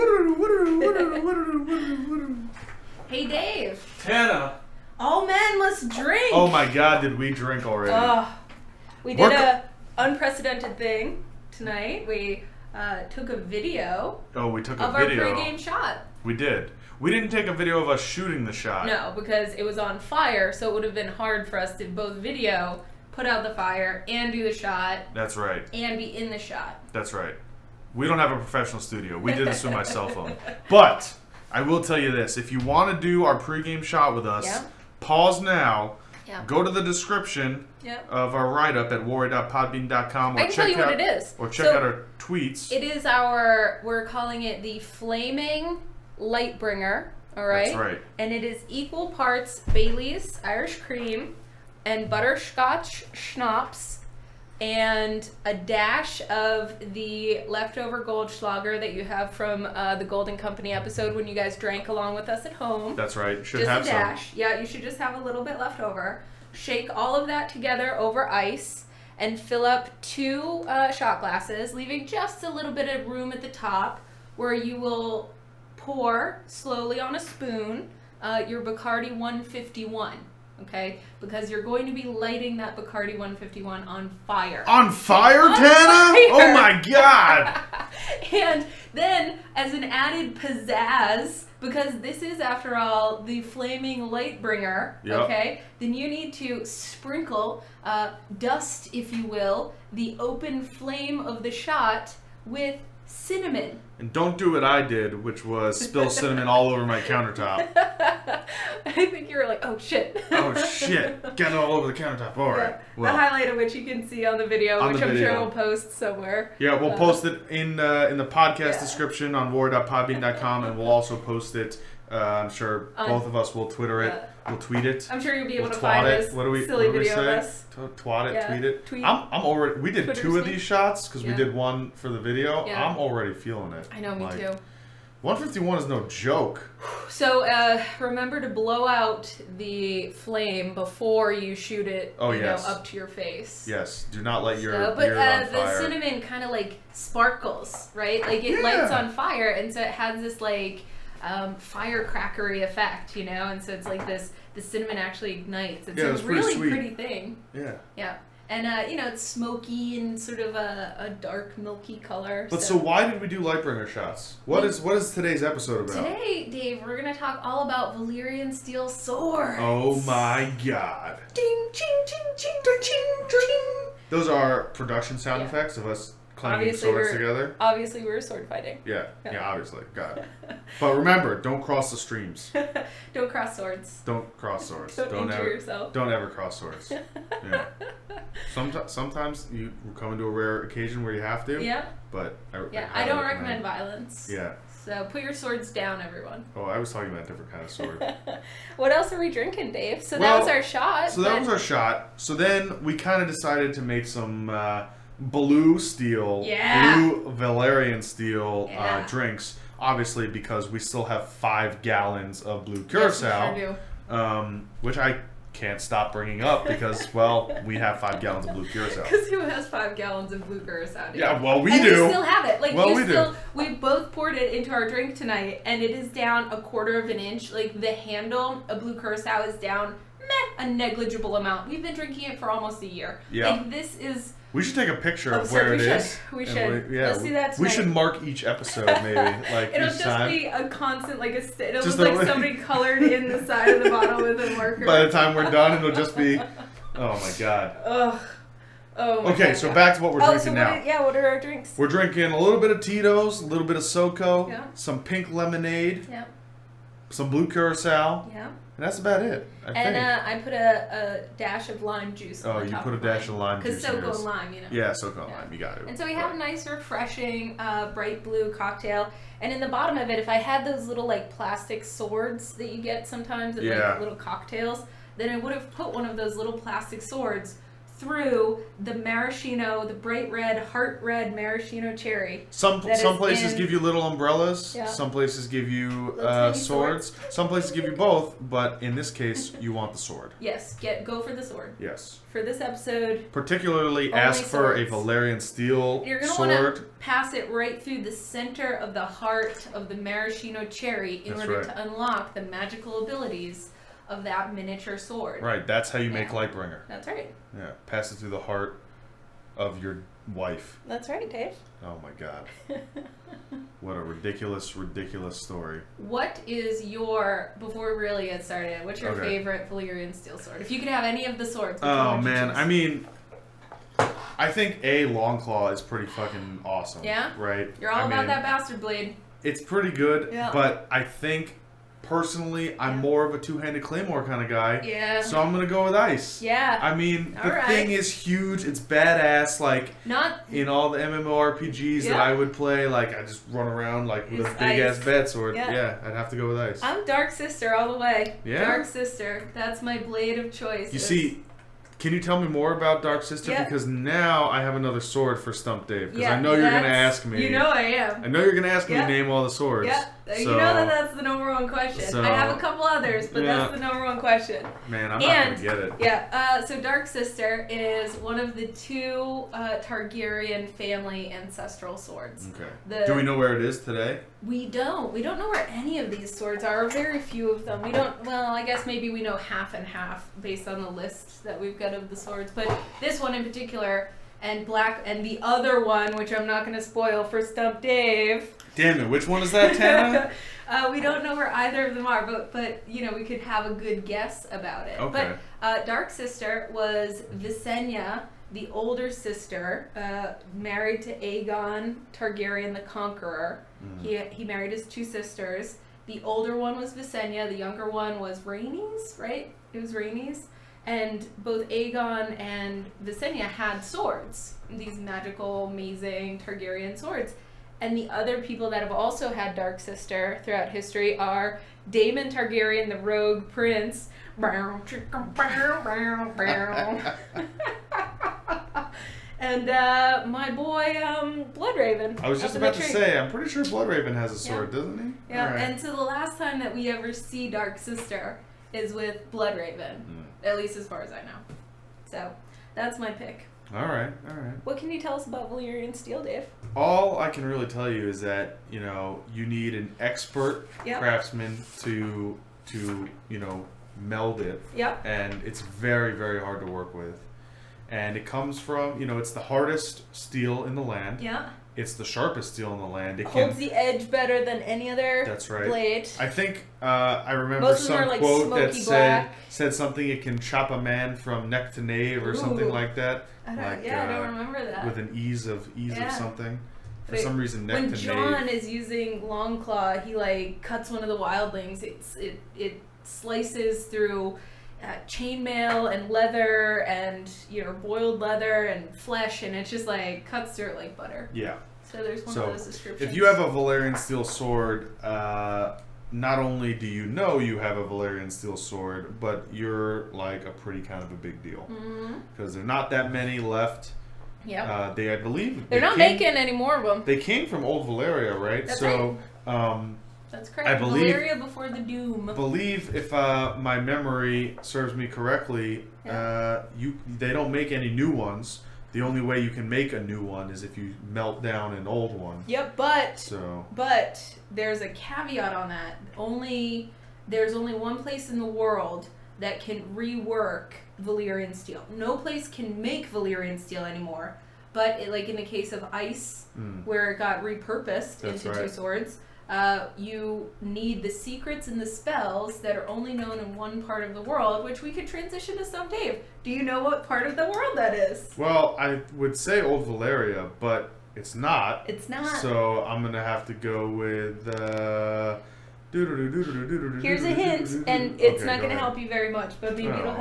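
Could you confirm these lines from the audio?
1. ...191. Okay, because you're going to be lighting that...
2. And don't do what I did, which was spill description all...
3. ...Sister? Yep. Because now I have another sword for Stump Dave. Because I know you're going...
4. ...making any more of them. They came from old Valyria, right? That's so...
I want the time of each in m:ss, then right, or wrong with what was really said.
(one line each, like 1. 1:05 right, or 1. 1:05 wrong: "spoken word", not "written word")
1. 1:19 wrong: "151", not "191"
2. 1:43 wrong: "cinnamon", not "description"
3. 5:53 right
4. 8:26 right.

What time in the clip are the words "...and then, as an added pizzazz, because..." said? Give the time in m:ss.
1:28.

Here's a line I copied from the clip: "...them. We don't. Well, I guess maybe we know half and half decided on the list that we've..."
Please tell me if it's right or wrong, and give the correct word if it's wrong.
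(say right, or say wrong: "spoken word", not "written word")
wrong: "based", not "decided".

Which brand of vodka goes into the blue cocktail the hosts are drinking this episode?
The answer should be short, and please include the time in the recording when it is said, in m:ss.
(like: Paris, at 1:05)
Tito's, at 4:12.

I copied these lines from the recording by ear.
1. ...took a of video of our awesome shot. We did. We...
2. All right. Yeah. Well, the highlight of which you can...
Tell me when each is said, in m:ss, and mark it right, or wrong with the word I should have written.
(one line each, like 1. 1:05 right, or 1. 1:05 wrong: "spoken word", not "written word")
1. 0:14 wrong: "pregame", not "awesome"
2. 1:52 right.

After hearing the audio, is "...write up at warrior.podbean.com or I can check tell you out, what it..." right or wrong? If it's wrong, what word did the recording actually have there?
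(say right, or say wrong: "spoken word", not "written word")
right.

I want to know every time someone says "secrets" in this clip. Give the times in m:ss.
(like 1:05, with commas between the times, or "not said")
9:01.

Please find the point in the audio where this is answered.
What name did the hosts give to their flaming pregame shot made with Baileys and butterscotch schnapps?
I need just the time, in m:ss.
0:44.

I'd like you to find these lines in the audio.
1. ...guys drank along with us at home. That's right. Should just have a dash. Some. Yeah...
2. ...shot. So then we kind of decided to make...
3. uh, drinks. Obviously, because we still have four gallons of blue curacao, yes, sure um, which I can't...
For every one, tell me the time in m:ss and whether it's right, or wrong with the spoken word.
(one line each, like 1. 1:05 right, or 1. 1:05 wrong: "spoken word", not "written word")
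1. 1:01 right
2. 3:21 right
3. 3:29 wrong: "five", not "four".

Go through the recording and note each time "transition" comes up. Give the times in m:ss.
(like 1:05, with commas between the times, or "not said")
9:05.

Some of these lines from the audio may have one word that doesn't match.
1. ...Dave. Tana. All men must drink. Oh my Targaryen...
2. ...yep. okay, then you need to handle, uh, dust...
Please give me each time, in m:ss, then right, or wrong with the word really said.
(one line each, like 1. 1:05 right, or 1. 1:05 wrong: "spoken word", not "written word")
1. 0:03 wrong: "God", not "Targaryen"
2. 1:35 wrong: "sprinkle", not "handle".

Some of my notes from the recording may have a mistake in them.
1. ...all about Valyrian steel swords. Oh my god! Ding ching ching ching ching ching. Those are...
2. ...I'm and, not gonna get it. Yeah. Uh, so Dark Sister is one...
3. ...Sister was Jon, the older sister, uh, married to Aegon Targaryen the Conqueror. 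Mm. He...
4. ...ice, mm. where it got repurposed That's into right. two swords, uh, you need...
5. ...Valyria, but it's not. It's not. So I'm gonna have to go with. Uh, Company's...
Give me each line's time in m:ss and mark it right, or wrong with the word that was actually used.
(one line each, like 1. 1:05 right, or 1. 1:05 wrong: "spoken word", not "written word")
1. 2:47 right
2. 6:05 right
3. 6:36 wrong: "Visenya", not "Jon"
4. 8:55 right
5. 9:09 wrong: "Here", not "Company".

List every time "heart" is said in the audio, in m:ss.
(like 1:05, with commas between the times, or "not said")
4:40, 4:59, 5:08.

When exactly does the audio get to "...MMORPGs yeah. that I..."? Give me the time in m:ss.
5:40.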